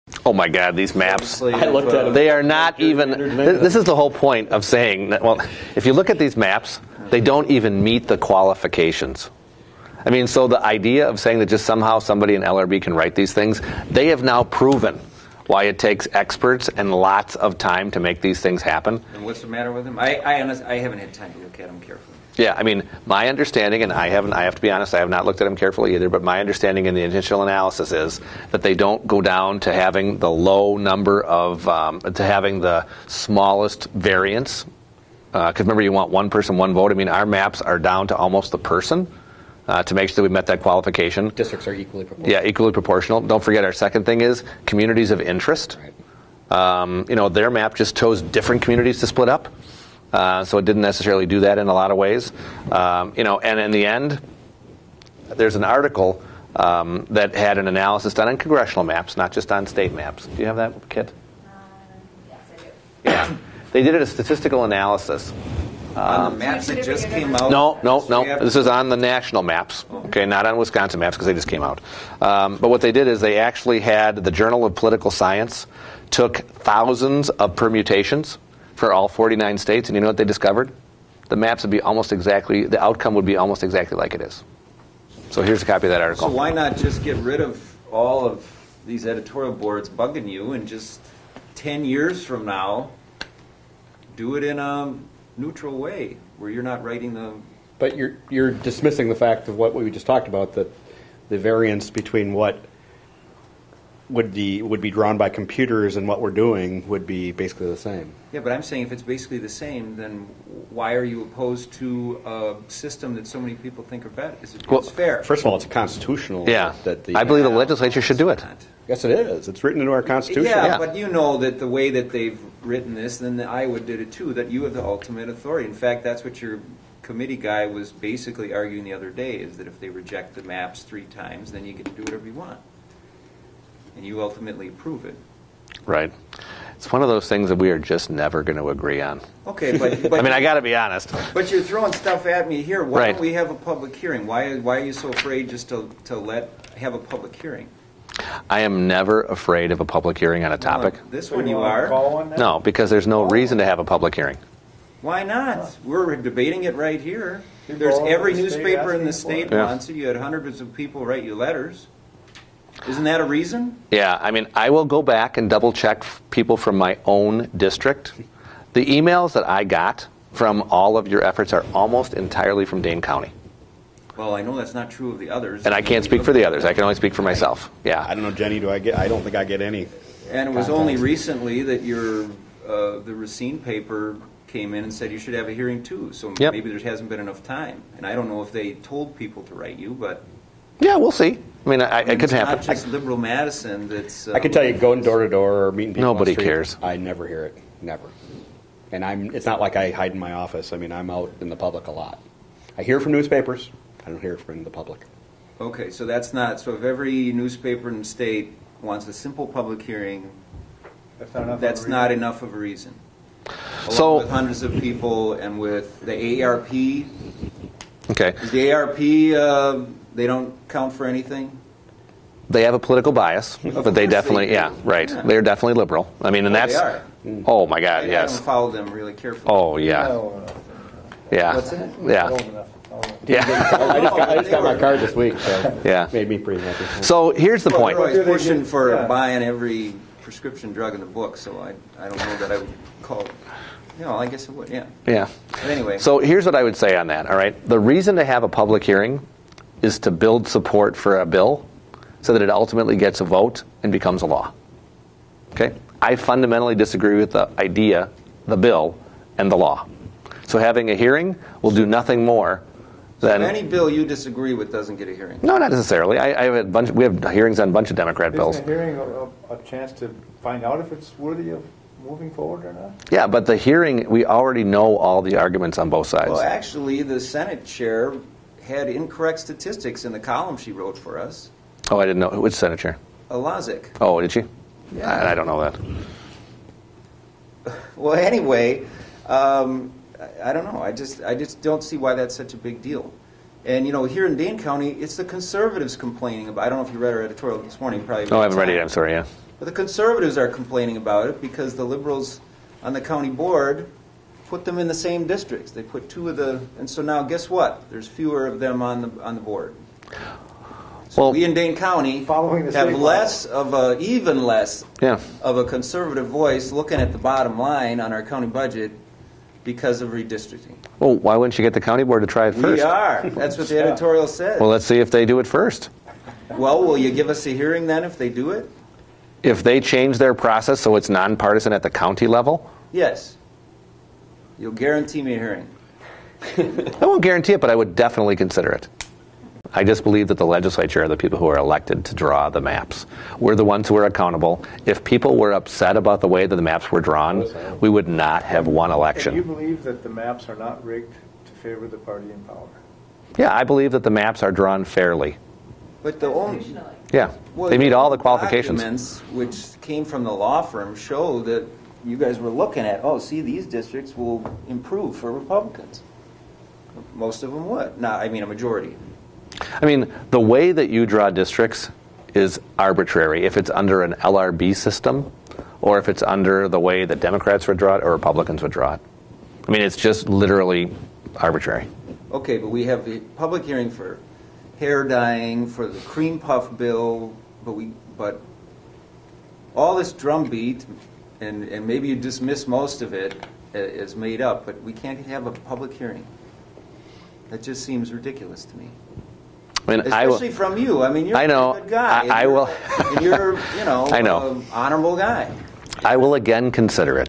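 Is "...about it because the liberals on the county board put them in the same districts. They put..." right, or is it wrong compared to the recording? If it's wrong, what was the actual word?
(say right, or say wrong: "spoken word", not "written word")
right.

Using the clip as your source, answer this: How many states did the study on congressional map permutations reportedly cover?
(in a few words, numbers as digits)
49.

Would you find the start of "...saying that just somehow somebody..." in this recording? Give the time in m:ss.
0:11.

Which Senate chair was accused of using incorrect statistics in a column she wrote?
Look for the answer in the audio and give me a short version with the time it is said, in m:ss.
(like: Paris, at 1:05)
Lazich, at 4:43.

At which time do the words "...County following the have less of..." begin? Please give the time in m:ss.
5:11.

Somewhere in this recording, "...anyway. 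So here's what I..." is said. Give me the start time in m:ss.
4:05.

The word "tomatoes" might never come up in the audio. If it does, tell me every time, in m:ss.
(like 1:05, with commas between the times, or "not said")
not said.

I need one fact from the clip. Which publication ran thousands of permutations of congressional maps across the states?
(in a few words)
Journal of Political Science.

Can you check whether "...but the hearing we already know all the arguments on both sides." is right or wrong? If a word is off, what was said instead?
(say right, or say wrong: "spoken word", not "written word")
right.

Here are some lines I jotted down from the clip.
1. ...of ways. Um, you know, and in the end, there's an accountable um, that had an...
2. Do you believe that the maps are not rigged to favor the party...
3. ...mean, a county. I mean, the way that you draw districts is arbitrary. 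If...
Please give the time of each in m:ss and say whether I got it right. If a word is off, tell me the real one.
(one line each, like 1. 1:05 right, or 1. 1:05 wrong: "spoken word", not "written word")
1. 0:51 wrong: "article", not "accountable"
2. 5:49 right
3. 6:08 wrong: "majority", not "county".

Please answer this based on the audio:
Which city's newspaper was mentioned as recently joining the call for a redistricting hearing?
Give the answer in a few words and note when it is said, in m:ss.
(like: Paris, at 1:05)
Racine, at 3:03.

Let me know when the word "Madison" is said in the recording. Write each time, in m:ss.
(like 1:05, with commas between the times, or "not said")
3:13.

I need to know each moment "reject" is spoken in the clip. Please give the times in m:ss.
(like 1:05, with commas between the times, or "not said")
2:09.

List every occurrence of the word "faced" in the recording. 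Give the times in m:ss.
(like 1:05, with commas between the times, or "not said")
not said.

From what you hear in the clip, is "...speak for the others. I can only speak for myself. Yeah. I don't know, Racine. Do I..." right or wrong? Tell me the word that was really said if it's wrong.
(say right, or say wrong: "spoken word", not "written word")
wrong: "Jenny", not "Racine".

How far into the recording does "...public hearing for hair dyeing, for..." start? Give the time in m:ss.
6:23.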